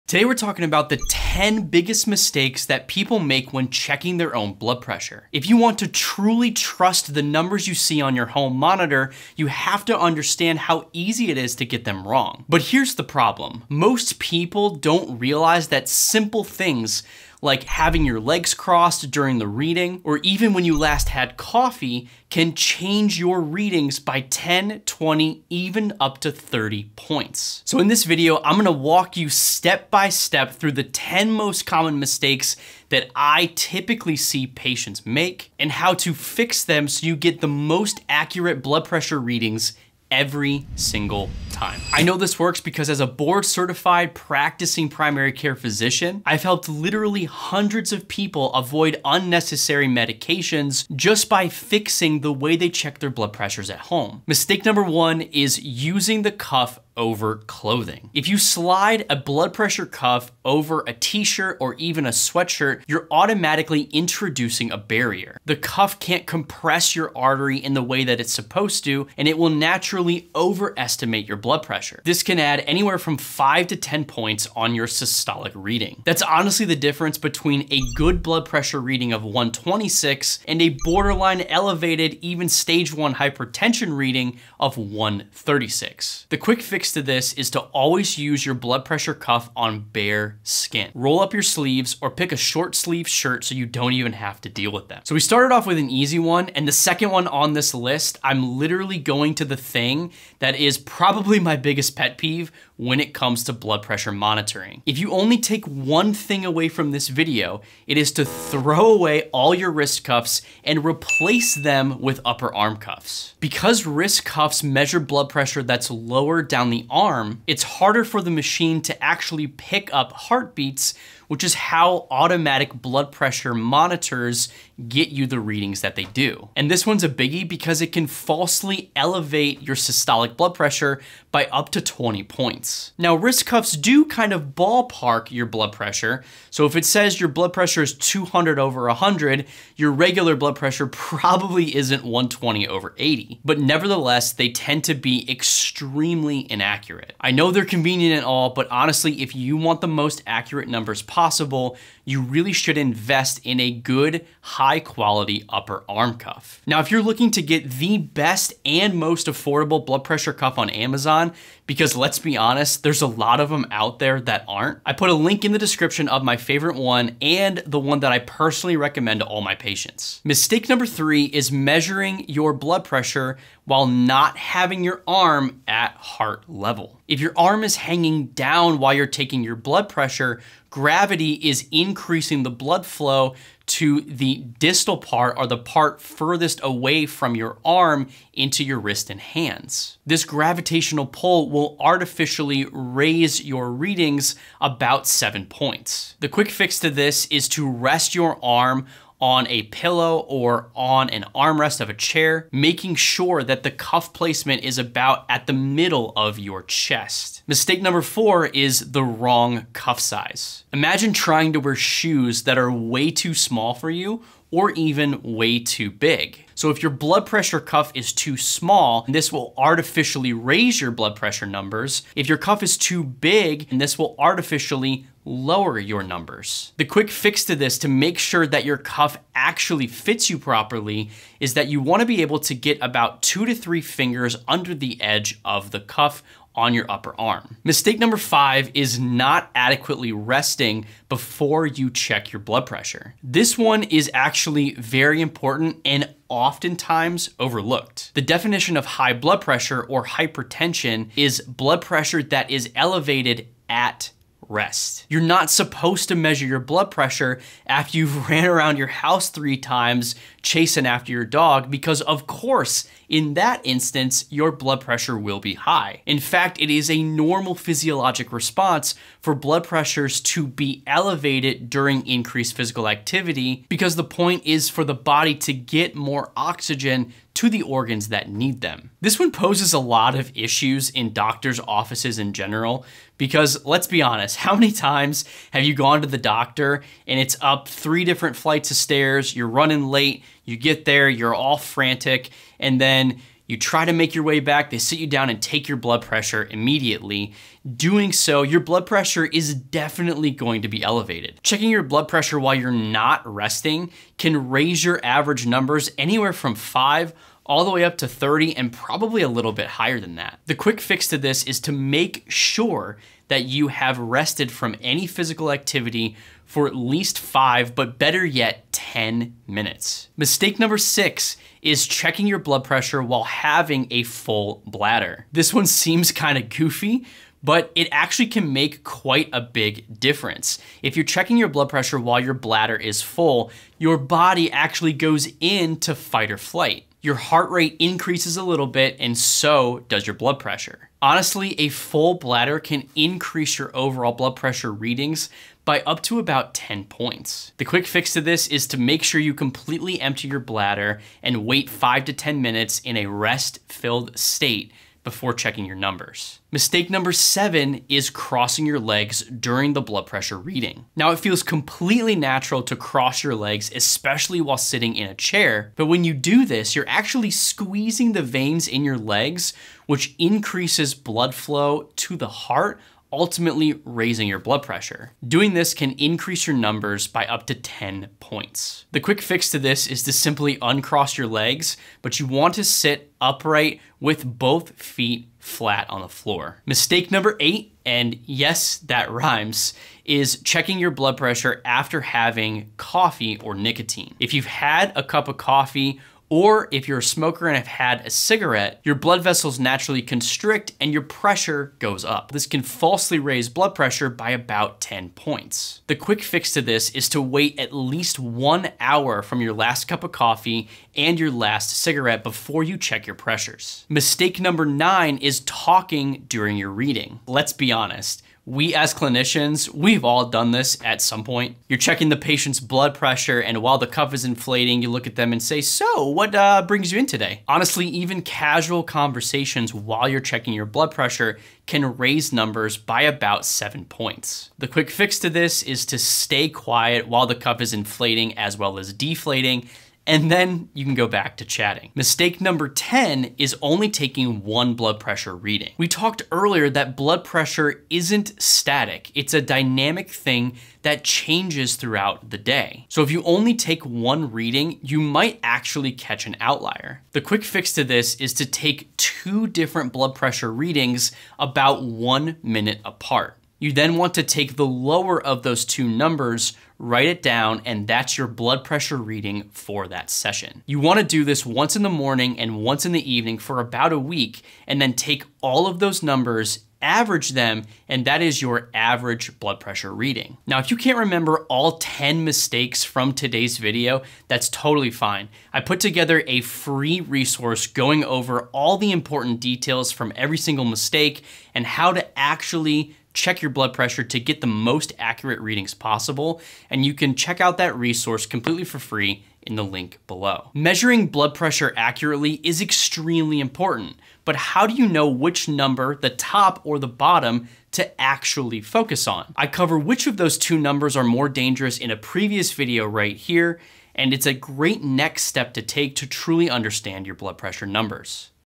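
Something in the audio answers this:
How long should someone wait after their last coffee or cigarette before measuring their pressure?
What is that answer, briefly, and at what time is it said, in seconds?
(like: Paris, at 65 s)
1 hour, at 408 s.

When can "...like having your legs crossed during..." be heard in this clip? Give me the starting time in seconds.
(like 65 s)
17 s.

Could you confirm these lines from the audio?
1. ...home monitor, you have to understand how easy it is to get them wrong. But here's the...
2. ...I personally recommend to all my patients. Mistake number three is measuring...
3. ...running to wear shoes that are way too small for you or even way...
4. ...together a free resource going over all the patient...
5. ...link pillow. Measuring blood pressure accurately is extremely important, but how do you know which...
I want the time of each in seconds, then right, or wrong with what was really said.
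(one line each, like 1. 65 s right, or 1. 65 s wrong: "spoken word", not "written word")
1. 8 s right
2. 168 s right
3. 211 s wrong: "trying", not "running"
4. 485 s wrong: "important", not "patient"
5. 499 s wrong: "below", not "pillow".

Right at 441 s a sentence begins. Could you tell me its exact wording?
Mistake number 10 is only taking one blood pressure reading.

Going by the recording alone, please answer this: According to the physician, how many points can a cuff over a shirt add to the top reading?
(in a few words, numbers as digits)
5 to 10.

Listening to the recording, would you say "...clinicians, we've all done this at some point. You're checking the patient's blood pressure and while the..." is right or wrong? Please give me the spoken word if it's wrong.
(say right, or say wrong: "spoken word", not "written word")
right.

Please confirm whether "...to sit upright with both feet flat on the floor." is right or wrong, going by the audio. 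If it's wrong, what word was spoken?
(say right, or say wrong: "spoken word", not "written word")
right.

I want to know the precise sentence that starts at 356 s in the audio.
Mistake number seven is crossing your legs during the blood pressure reading.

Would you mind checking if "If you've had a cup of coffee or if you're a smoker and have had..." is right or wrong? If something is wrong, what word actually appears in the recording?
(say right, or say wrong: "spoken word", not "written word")
right.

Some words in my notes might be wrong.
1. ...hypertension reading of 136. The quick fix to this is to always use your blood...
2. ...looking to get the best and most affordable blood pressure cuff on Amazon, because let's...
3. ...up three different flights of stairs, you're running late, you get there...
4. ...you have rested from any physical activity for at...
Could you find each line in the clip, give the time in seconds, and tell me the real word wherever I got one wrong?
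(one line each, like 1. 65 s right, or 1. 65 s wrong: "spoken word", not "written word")
1. 83 s right
2. 157 s right
3. 287 s right
4. 313 s right.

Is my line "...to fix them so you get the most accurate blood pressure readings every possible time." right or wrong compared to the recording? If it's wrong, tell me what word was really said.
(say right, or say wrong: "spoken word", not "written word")
wrong: "single", not "possible".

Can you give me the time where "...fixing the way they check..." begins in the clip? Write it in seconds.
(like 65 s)
51 s.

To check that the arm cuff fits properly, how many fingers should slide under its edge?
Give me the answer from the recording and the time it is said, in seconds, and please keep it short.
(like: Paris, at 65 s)
2 to 3, at 233 s.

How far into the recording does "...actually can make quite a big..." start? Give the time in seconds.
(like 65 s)
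327 s.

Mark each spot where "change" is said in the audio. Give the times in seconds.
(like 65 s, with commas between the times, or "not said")
22 s, 451 s.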